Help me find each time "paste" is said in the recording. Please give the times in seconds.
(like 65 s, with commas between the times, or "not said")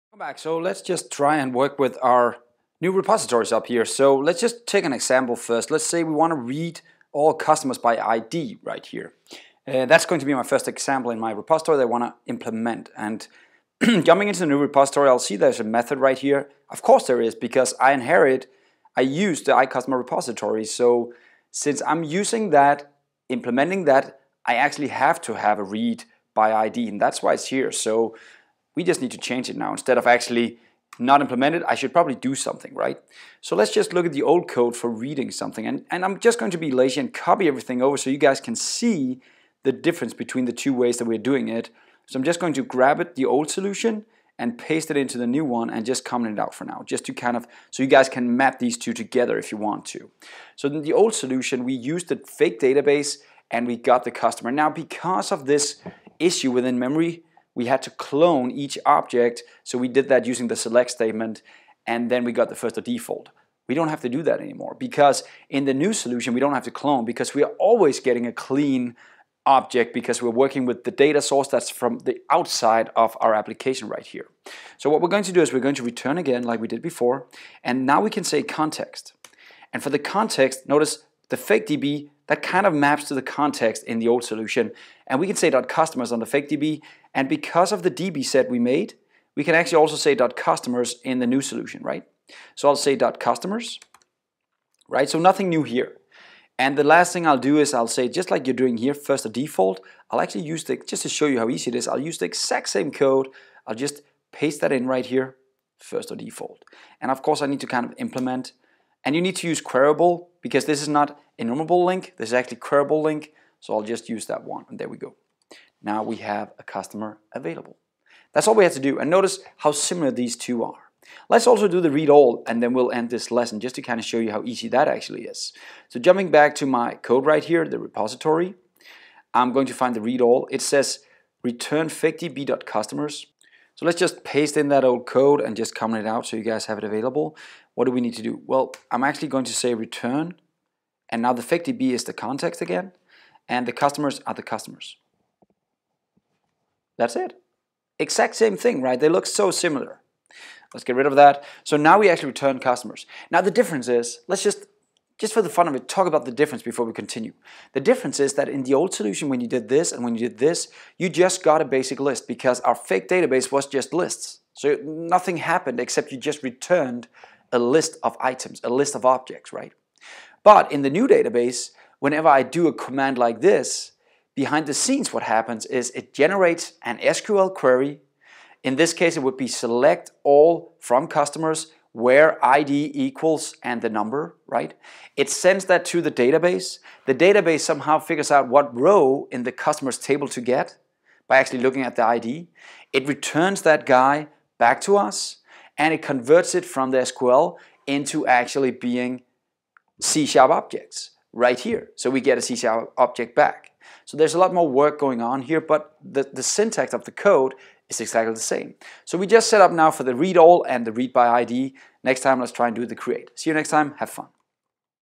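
44 s, 104 s, 134 s.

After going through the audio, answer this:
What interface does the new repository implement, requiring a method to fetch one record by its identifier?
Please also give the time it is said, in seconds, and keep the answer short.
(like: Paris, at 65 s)
ICustomer repository, at 19 s.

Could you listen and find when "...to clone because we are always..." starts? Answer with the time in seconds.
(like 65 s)
66 s.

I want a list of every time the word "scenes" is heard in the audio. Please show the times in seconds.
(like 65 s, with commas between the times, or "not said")
174 s.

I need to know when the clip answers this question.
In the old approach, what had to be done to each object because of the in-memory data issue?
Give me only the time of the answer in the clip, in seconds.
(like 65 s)
57 s.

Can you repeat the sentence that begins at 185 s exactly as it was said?
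It sends that to the database.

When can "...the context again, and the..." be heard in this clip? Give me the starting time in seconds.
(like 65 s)
142 s.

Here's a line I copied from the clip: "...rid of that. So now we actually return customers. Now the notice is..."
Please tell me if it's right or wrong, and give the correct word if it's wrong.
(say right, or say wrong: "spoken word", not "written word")
wrong: "difference", not "notice".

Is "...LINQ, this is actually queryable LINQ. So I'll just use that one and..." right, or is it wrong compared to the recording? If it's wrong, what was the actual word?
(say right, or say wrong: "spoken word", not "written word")
right.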